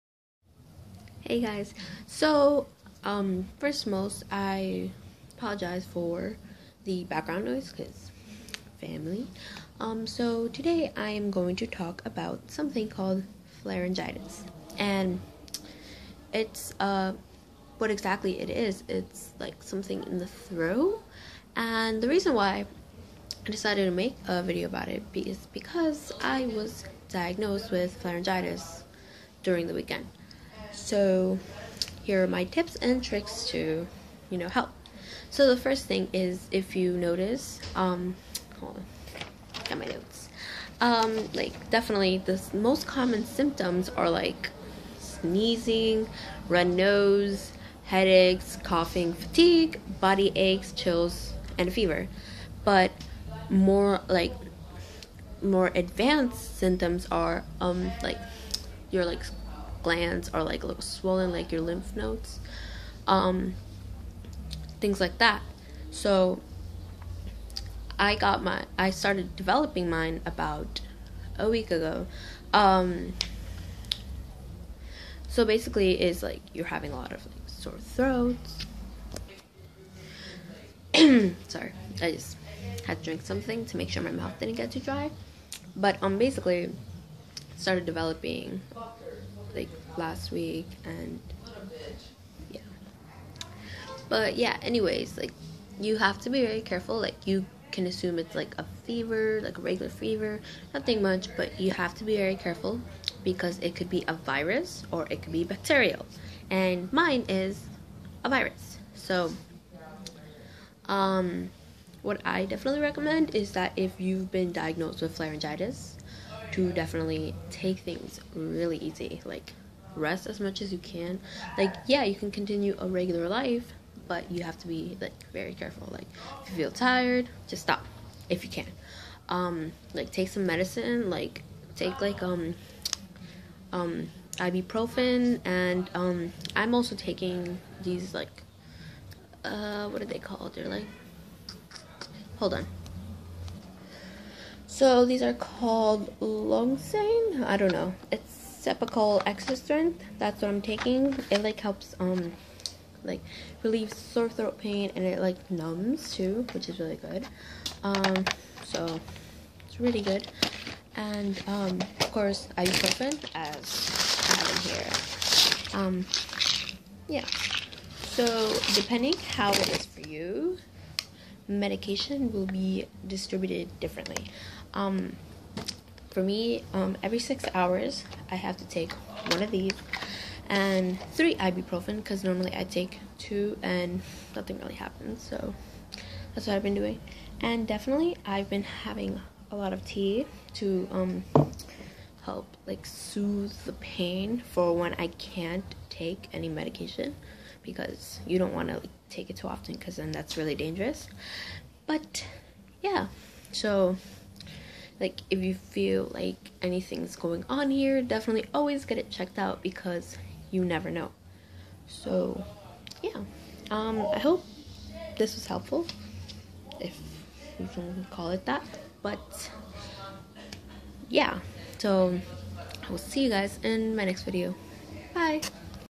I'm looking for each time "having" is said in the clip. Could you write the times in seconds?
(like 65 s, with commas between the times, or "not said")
76 s, 188 s.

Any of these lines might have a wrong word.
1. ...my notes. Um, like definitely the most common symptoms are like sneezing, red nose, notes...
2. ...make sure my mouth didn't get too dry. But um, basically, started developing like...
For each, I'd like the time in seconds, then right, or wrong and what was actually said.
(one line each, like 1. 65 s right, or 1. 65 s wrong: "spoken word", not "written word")
1. 39 s wrong: "headaches", not "notes"
2. 83 s right.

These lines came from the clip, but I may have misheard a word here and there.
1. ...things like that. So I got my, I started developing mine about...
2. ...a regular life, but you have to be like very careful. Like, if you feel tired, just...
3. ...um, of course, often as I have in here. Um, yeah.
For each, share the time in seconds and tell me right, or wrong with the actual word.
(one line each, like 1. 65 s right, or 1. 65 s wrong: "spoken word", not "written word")
1. 64 s right
2. 122 s right
3. 161 s wrong: "ibuprofen", not "often".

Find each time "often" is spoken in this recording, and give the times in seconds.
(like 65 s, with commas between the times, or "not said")
199 s.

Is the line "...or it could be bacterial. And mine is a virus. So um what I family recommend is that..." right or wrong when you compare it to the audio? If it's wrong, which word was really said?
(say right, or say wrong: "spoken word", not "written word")
wrong: "definitely", not "family".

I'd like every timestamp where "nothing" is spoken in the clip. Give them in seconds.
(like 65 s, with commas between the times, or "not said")
100 s, 184 s.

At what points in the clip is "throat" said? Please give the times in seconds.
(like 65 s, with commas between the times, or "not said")
20 s, 77 s, 154 s.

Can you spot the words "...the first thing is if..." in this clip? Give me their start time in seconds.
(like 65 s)
35 s.